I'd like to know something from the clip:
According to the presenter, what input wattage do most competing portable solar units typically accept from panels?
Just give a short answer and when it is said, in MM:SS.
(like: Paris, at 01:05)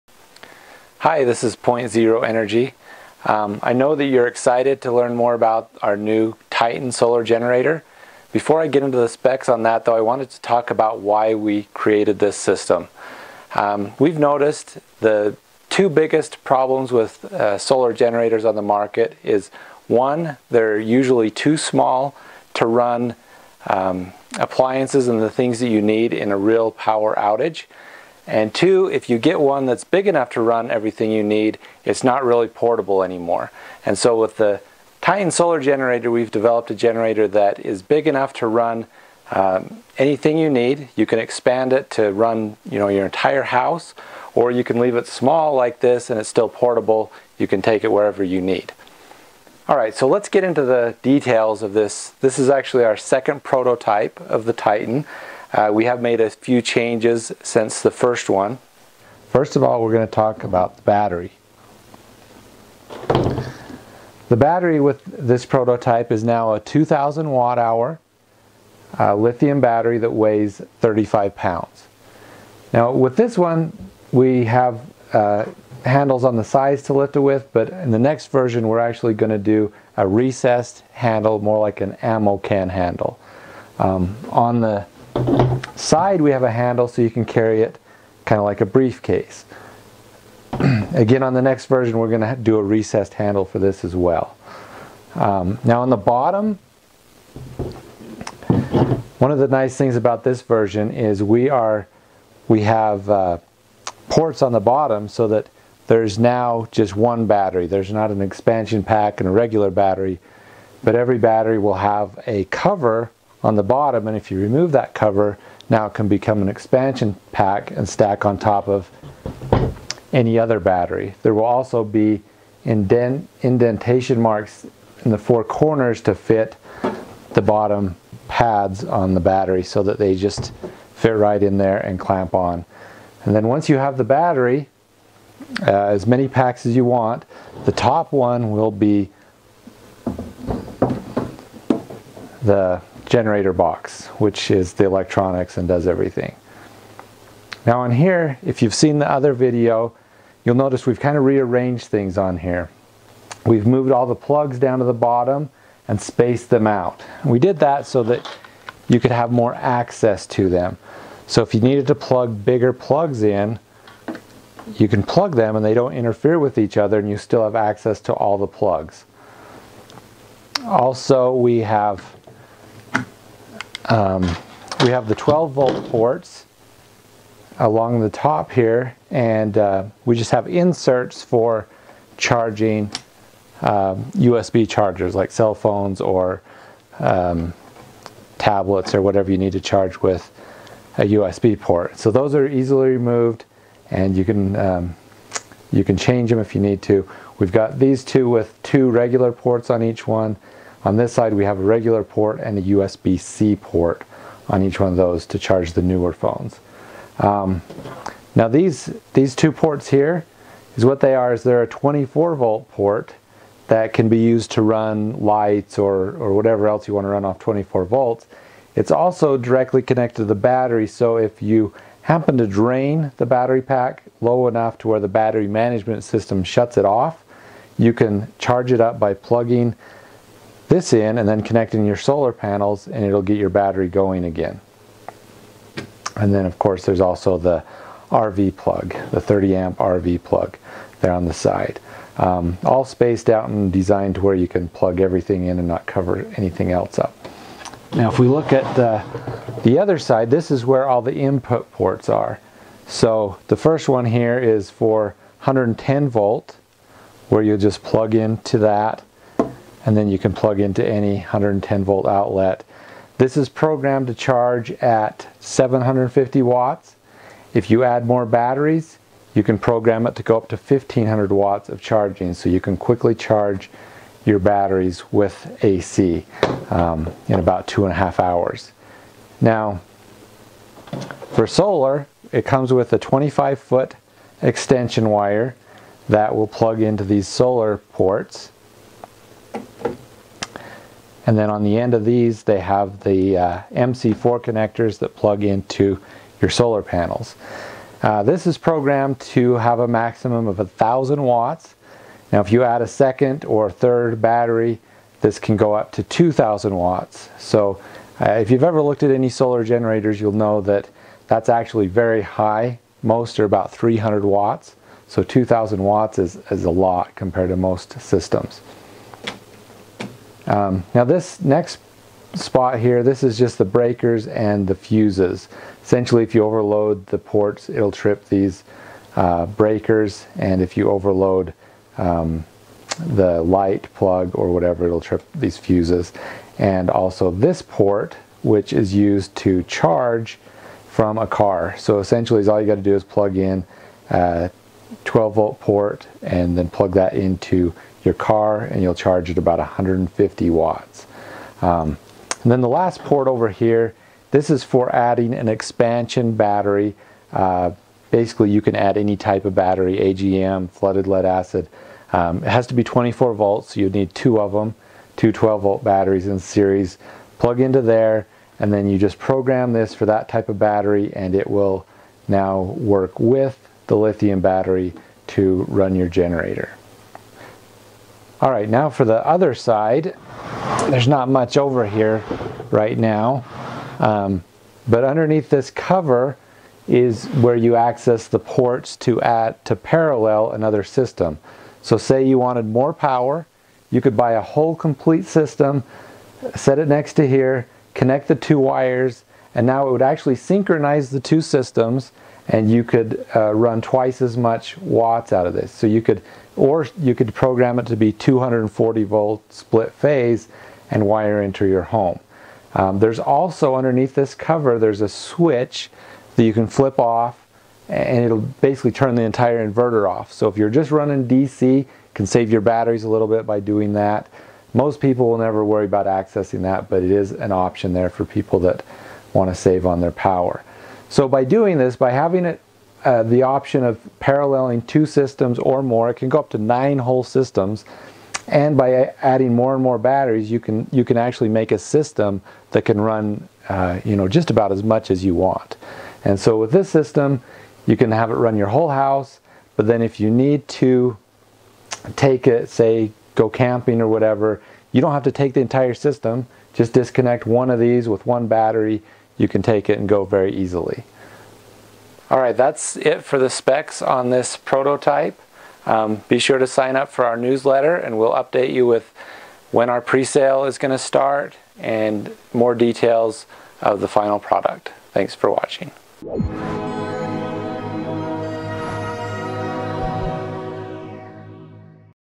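300 watts, at 05:13.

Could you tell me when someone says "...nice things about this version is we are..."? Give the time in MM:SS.
01:39.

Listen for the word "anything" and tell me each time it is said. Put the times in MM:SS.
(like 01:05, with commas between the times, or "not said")
00:39, 04:06.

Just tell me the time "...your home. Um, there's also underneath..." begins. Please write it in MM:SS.
06:51.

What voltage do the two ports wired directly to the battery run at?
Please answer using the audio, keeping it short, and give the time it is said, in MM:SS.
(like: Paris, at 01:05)
24 volt, at 03:31.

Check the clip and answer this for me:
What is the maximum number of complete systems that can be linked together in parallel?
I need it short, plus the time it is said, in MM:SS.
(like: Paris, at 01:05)
9, at 07:16.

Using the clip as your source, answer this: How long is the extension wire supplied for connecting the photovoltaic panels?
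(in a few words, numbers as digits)
25 feet.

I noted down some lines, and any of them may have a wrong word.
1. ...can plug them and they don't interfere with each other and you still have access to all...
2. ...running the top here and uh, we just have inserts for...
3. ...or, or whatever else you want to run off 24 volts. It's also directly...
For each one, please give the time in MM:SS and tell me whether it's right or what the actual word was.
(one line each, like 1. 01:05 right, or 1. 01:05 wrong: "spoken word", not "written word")
1. 02:44 right
2. 02:57 wrong: "along", not "running"
3. 03:35 right.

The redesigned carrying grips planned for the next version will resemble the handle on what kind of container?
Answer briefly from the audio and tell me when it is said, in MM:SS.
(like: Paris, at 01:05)
ammo can, at 01:22.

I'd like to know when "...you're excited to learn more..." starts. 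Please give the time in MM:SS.
00:04.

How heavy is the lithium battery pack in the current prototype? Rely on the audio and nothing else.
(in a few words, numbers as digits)
35 pounds.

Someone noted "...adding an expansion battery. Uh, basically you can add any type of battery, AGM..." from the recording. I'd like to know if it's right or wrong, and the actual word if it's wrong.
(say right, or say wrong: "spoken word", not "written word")
right.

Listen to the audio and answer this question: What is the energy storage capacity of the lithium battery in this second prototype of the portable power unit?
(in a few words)
2,000 watt hours.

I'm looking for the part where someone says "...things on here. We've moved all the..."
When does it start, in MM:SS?
02:31.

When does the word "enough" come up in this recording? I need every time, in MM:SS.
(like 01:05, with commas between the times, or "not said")
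00:30, 00:38, 03:44.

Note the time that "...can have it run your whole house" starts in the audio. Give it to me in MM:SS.
07:27.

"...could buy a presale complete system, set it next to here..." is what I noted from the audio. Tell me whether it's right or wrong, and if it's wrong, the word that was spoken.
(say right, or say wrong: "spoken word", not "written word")
wrong: "whole", not "presale".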